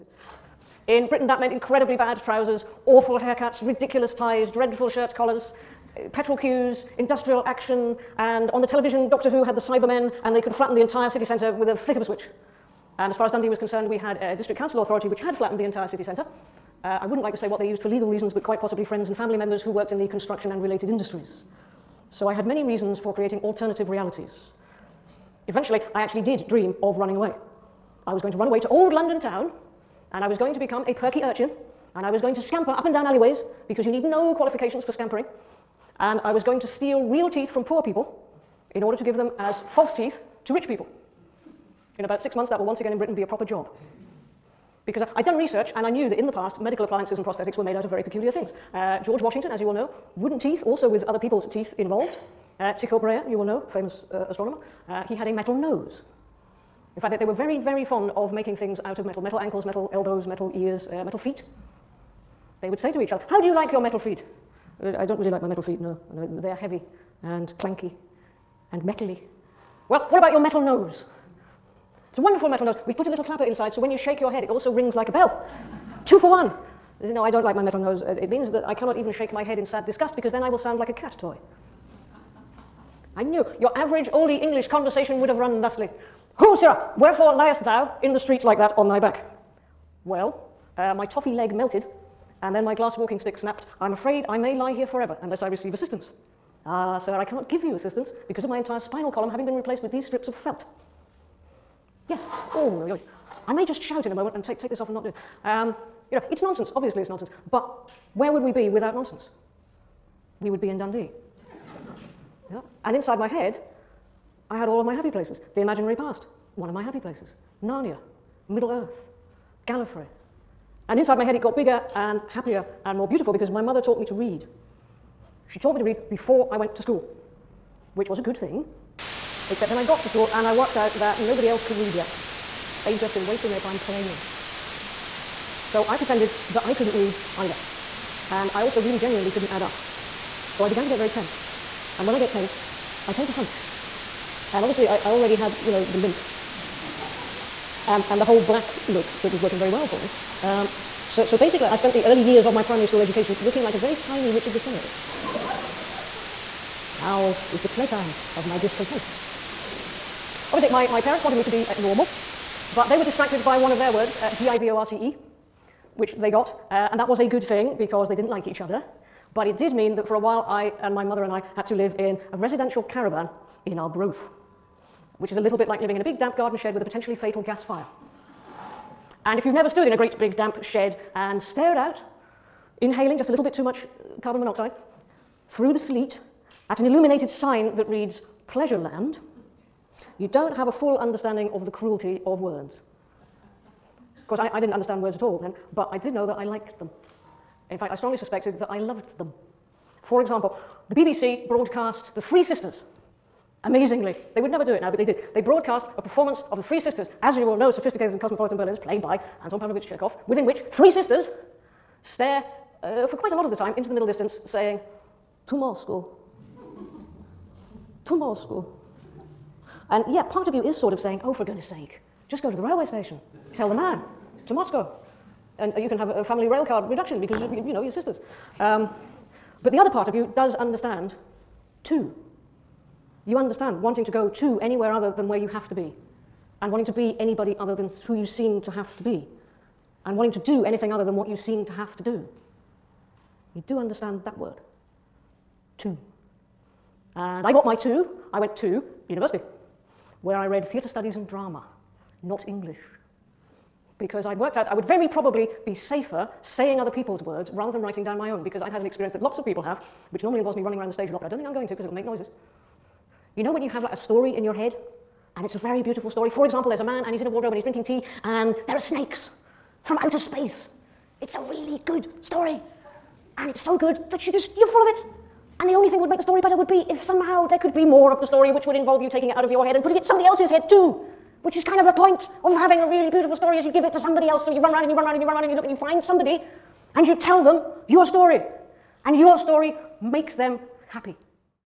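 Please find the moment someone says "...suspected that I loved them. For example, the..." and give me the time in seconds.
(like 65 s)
198 s.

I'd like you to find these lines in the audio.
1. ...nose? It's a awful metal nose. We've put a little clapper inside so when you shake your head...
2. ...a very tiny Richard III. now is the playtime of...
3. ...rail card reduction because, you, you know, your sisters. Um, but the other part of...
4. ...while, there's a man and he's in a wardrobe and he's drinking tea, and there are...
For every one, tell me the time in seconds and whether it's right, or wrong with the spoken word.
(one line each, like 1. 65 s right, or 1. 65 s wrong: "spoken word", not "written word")
1. 70 s wrong: "wonderful", not "awful"
2. 153 s right
3. 226 s right
4. 266 s wrong: "example", not "while".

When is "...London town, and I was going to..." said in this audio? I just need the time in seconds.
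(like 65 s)
28 s.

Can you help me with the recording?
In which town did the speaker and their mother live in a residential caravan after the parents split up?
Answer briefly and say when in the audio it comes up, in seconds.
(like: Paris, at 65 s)
Arbroath, at 173 s.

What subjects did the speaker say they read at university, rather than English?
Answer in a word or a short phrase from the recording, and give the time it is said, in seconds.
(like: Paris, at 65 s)
Theatre studies and drama, at 250 s.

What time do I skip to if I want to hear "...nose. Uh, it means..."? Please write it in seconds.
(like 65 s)
77 s.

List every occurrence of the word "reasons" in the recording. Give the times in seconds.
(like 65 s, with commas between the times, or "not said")
18 s, 22 s.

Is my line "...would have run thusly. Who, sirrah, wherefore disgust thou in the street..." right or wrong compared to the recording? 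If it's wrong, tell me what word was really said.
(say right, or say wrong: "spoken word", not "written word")
wrong: "liest", not "disgust".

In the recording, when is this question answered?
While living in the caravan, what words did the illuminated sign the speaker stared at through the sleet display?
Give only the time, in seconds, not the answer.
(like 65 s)
188 s.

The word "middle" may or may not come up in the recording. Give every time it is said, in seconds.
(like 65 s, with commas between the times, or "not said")
118 s, 213 s.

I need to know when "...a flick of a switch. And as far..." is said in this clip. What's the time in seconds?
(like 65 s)
11 s.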